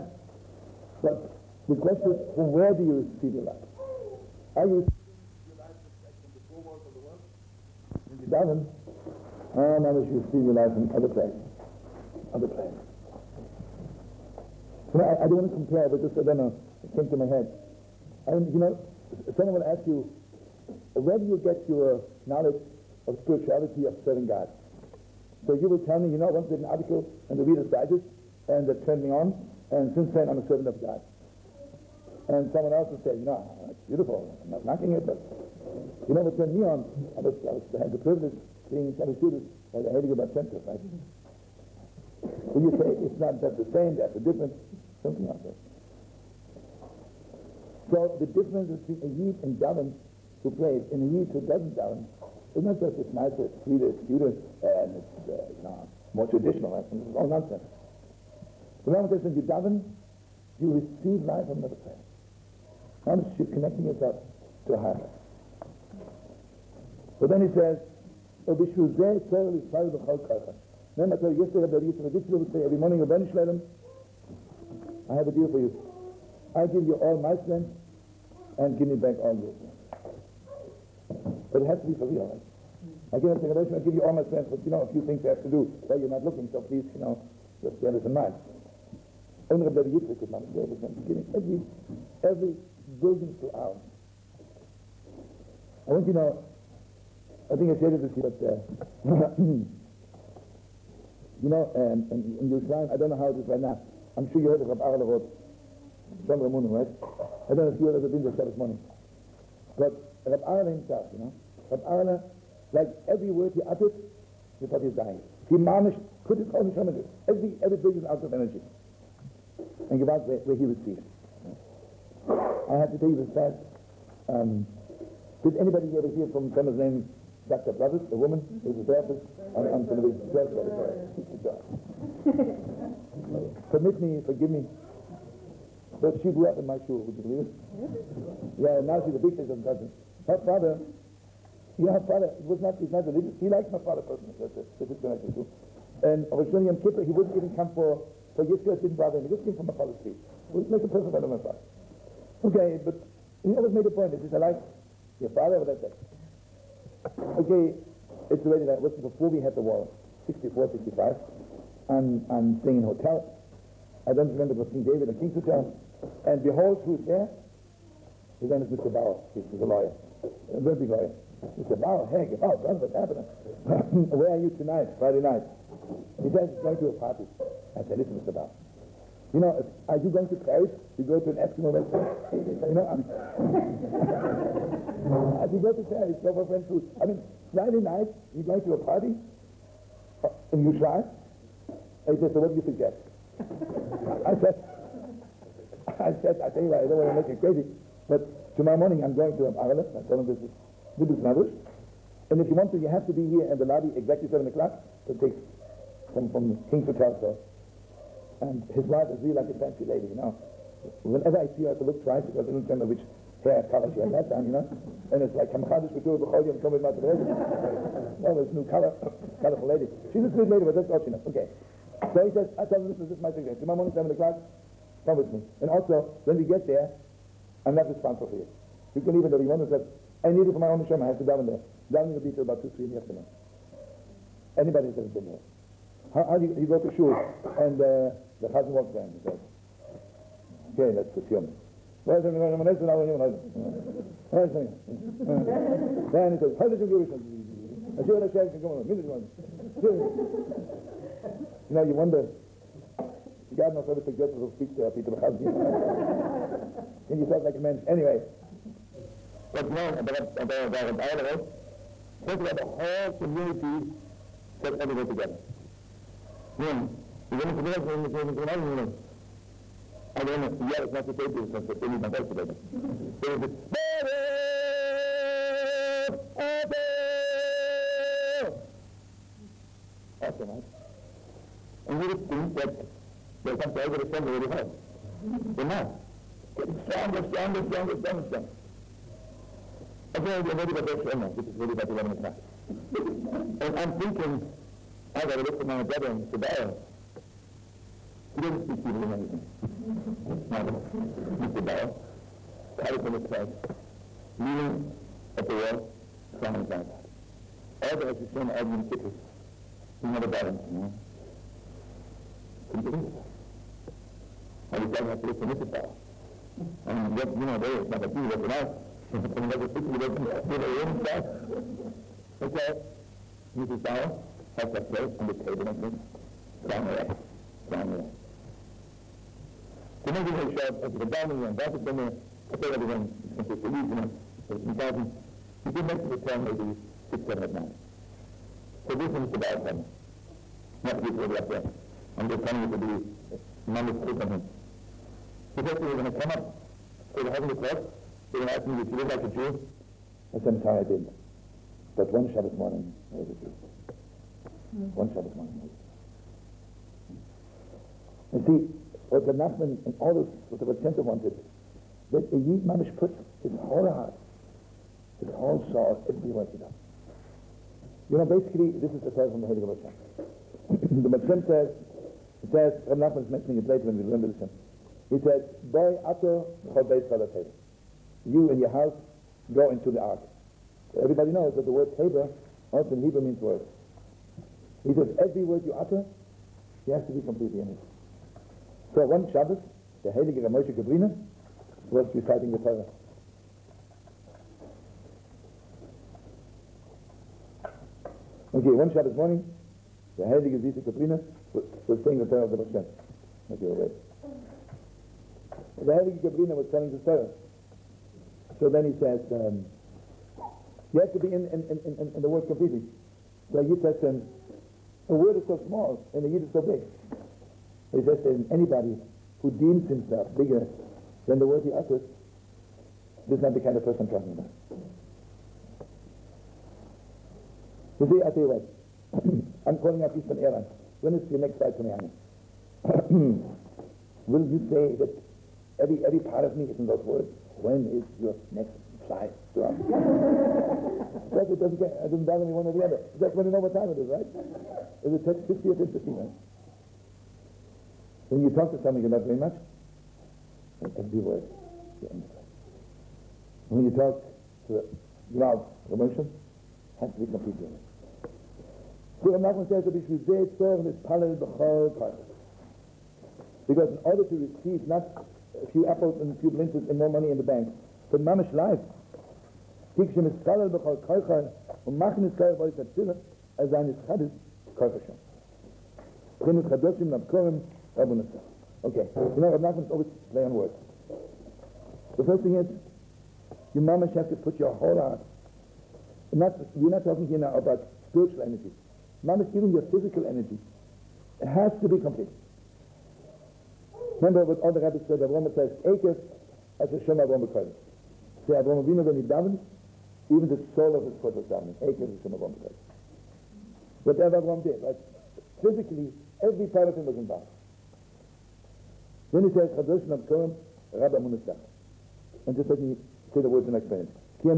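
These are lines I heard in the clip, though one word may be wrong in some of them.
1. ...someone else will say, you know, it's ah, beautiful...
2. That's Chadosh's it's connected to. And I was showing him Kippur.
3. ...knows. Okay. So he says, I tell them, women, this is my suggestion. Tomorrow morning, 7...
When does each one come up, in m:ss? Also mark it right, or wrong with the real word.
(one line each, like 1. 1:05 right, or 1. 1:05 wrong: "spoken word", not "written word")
1. 0:32 right
2. 2:24 wrong: "That", not "Chadosh"
3. 3:41 wrong: "listen", not "women".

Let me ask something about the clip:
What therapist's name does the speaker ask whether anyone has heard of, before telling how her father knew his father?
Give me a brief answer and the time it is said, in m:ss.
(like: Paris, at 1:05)
Dr. Brothers, at 2:07.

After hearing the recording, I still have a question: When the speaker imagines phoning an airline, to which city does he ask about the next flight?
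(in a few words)
Miami.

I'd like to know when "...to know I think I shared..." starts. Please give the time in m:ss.
1:36.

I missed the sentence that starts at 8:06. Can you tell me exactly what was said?
Not, we're not talking here now about spiritual energy.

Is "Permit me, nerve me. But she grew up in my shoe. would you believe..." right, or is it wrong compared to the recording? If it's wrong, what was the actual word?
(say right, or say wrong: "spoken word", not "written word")
wrong: "forgive", not "nerve".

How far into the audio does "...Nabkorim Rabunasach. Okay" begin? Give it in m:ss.
7:57.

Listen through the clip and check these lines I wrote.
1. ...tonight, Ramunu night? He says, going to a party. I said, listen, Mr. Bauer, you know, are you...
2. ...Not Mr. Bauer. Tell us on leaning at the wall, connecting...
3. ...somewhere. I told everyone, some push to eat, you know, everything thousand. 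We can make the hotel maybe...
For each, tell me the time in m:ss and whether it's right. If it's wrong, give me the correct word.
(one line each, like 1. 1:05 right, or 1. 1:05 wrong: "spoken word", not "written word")
1. 2:54 wrong: "Friday", not "Ramunu"
2. 5:00 wrong: "crying", not "connecting"
3. 5:31 right.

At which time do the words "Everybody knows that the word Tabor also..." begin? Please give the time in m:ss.
6:21.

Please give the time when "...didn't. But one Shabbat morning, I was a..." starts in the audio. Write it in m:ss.
5:50.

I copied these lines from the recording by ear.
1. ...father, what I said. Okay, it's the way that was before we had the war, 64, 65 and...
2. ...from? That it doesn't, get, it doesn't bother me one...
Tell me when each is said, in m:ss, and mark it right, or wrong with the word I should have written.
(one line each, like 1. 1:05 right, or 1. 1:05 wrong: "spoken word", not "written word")
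1. 2:35 right
2. 7:19 right.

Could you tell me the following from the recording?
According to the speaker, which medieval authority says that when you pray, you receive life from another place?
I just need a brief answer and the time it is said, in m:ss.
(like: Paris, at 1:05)
The Rambam, at 0:58.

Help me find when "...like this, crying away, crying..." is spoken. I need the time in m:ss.
5:25.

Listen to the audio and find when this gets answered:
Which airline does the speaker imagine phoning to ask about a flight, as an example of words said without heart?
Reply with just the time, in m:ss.
7:10.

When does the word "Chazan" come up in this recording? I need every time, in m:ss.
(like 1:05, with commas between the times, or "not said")
4:15.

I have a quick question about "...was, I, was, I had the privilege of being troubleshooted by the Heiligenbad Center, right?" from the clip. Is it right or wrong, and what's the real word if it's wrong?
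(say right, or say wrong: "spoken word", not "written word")
right.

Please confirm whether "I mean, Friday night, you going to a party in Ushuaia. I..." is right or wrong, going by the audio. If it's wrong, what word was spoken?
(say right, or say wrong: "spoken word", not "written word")
right.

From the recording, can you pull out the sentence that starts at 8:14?
Remember what all the rabbis said, Avraham says, Akers as Hashem Avram B'Kodesh.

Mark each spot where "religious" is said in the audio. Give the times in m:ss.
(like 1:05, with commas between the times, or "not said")
2:23.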